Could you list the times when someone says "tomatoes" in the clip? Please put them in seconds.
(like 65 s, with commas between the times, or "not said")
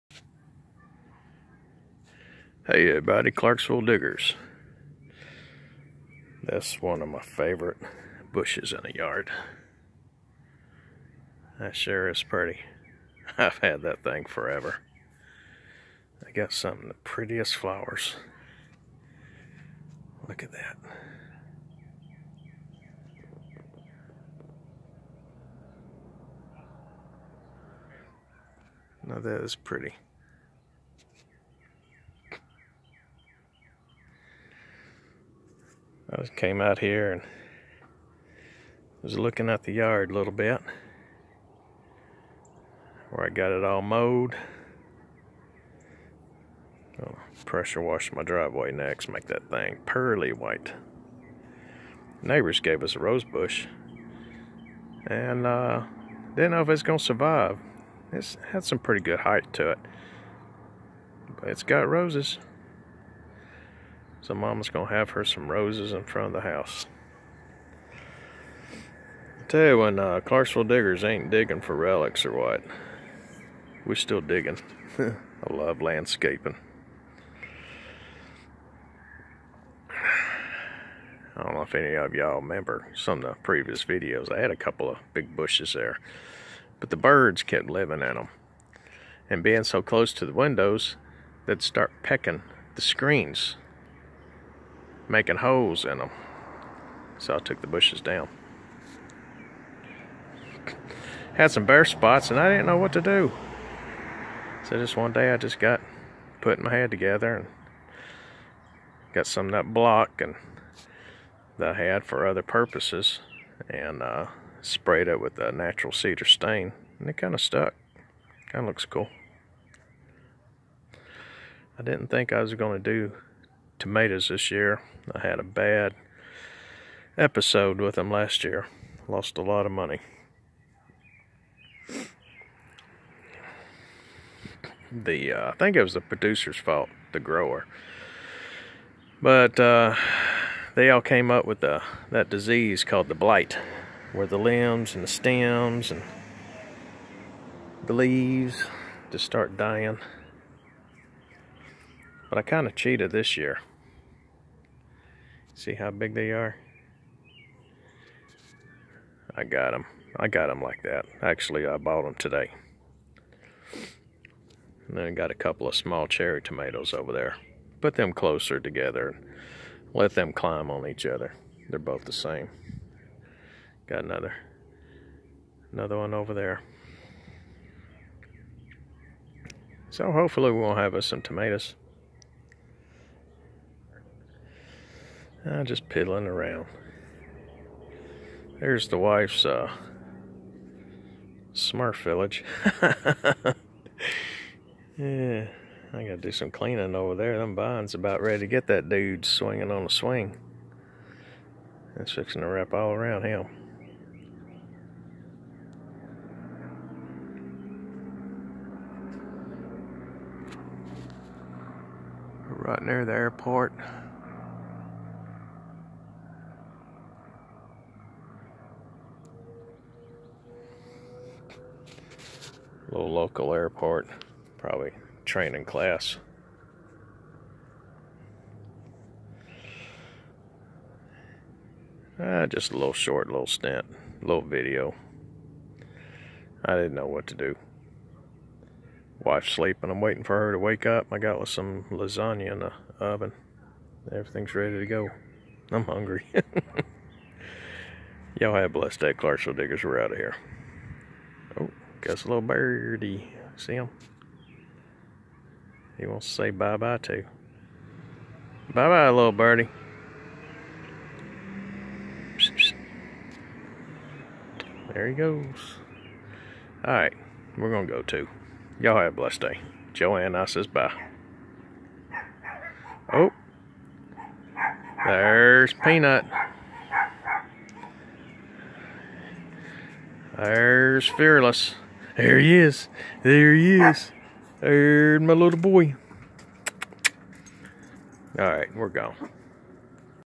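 123 s, 166 s, 181 s.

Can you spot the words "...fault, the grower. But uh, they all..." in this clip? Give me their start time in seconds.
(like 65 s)
136 s.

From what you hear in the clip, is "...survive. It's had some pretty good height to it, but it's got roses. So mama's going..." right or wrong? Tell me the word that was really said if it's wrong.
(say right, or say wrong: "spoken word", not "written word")
right.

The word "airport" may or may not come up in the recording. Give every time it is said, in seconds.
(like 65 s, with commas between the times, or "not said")
213 s, 223 s.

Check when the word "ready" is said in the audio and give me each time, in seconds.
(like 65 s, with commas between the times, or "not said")
198 s, 244 s.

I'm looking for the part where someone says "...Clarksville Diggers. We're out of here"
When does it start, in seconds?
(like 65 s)
249 s.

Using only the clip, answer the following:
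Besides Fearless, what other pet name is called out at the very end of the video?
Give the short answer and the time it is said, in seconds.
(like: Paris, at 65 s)
Peanut, at 275 s.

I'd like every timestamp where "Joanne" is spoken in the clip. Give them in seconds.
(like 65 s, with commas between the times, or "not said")
269 s.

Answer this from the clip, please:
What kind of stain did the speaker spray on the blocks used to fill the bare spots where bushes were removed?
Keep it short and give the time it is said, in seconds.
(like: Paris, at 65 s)
Natural cedar stain, at 115 s.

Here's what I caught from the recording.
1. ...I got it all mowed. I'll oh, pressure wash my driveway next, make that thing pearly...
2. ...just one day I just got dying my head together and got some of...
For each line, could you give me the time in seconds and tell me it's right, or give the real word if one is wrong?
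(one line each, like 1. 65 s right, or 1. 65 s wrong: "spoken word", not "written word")
1. 43 s right
2. 104 s wrong: "putting", not "dying".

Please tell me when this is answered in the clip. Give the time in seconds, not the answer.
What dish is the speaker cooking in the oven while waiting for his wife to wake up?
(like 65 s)
241 s.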